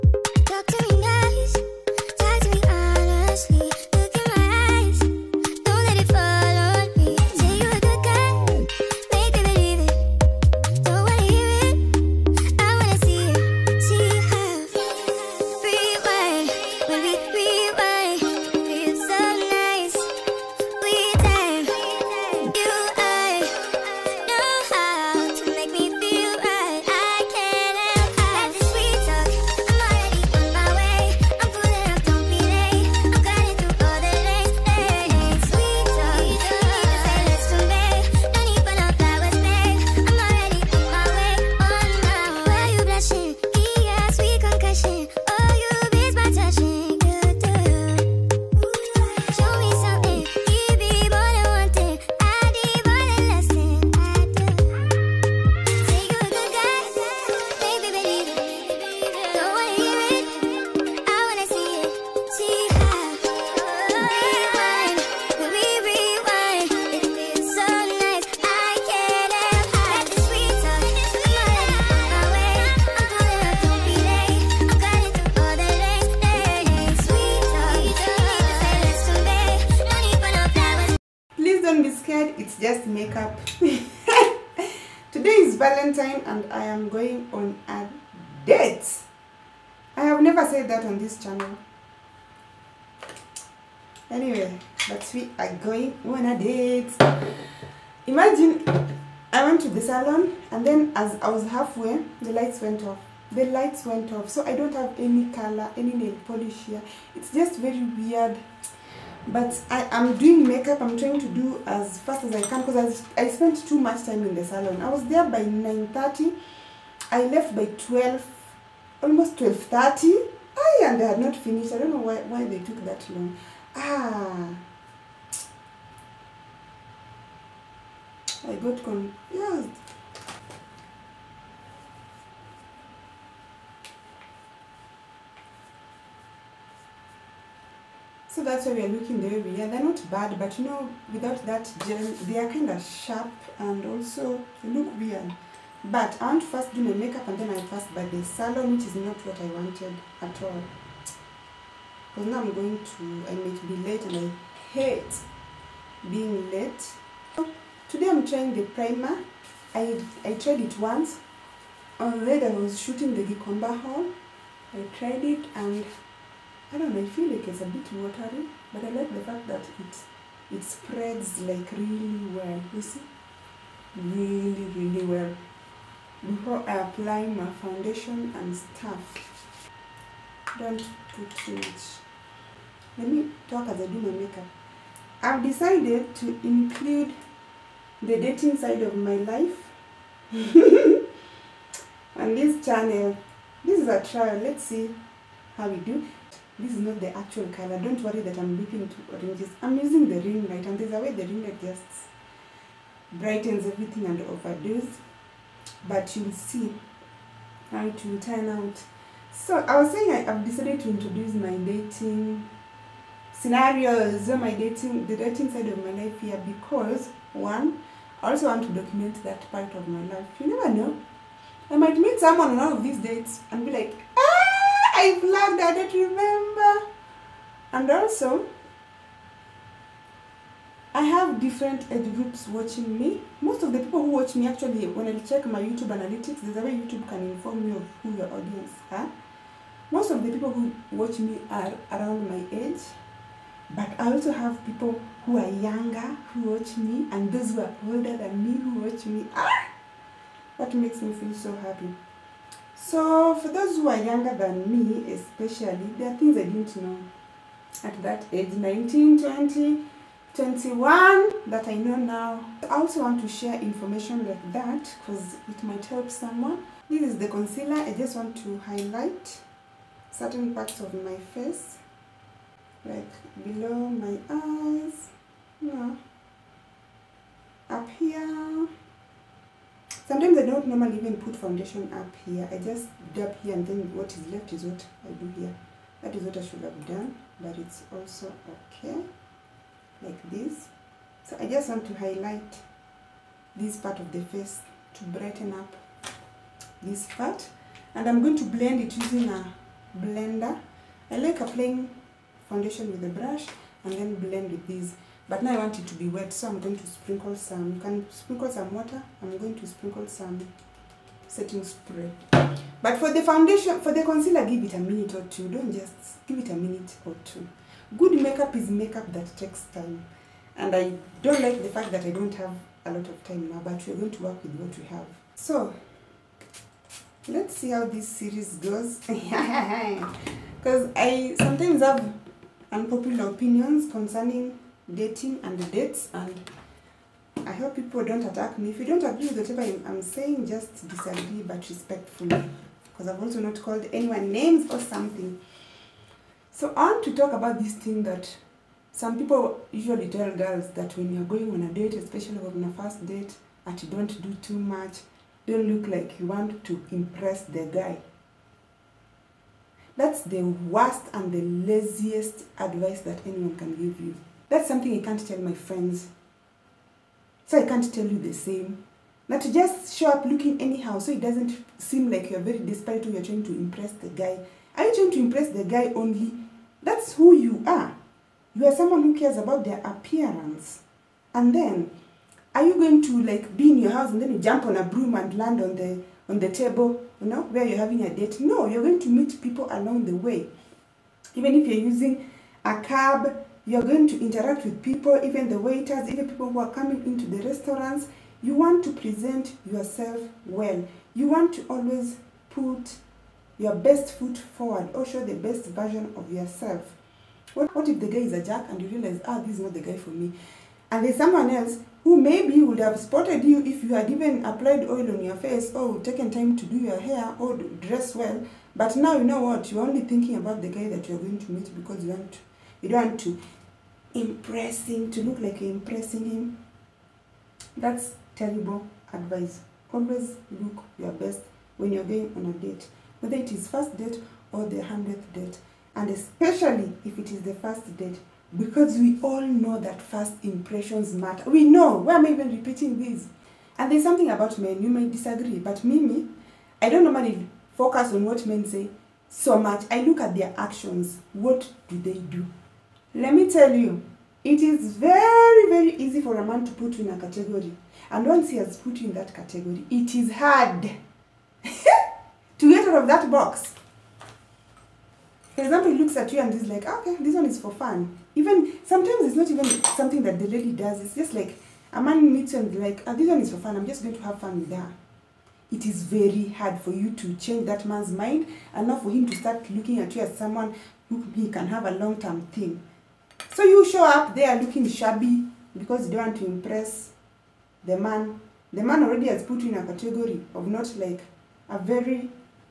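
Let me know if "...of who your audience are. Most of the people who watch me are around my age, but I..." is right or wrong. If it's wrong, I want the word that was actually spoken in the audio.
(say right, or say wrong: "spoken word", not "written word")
right.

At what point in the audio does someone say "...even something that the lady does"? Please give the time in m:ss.
7:49.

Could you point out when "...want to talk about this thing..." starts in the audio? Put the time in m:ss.
5:46.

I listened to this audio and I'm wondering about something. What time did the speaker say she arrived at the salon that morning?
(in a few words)
9:30.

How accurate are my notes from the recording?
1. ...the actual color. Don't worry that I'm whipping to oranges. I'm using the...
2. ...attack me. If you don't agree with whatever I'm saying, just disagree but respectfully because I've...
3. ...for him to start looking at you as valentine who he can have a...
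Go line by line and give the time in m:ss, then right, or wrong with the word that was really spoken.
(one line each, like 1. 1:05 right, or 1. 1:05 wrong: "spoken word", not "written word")
1. 3:16 right
2. 5:38 right
3. 7:59 wrong: "someone", not "valentine".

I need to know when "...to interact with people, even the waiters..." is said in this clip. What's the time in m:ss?
6:34.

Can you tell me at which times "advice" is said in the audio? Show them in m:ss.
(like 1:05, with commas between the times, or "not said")
6:02, 7:09.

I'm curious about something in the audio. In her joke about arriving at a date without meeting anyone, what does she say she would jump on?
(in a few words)
a broom.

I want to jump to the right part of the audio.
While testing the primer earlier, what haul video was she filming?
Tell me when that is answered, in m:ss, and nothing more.
2:43.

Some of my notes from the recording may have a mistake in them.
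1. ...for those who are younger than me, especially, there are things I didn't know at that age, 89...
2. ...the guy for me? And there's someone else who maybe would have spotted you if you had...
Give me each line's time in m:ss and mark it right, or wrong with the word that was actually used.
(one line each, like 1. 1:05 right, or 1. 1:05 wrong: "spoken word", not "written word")
1. 4:13 wrong: "19", not "89"
2. 6:49 right.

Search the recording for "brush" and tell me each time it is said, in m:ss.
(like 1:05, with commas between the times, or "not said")
5:03.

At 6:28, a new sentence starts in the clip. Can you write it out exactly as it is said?
No, you're going to meet people along the way.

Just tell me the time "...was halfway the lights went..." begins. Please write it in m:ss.
1:41.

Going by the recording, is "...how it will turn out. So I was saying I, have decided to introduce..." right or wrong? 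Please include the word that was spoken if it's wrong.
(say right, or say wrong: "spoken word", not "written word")
right.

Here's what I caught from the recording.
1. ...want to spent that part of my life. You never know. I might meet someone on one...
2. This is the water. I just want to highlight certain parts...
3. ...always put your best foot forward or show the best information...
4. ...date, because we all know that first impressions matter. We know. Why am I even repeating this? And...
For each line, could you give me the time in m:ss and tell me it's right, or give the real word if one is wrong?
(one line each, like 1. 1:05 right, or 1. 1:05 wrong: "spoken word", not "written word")
1. 3:38 wrong: "document", not "spent"
2. 4:26 wrong: "concealer", not "water"
3. 6:41 wrong: "version", not "information"
4. 7:17 right.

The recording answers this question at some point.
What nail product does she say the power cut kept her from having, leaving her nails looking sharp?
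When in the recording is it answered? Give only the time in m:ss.
2:21.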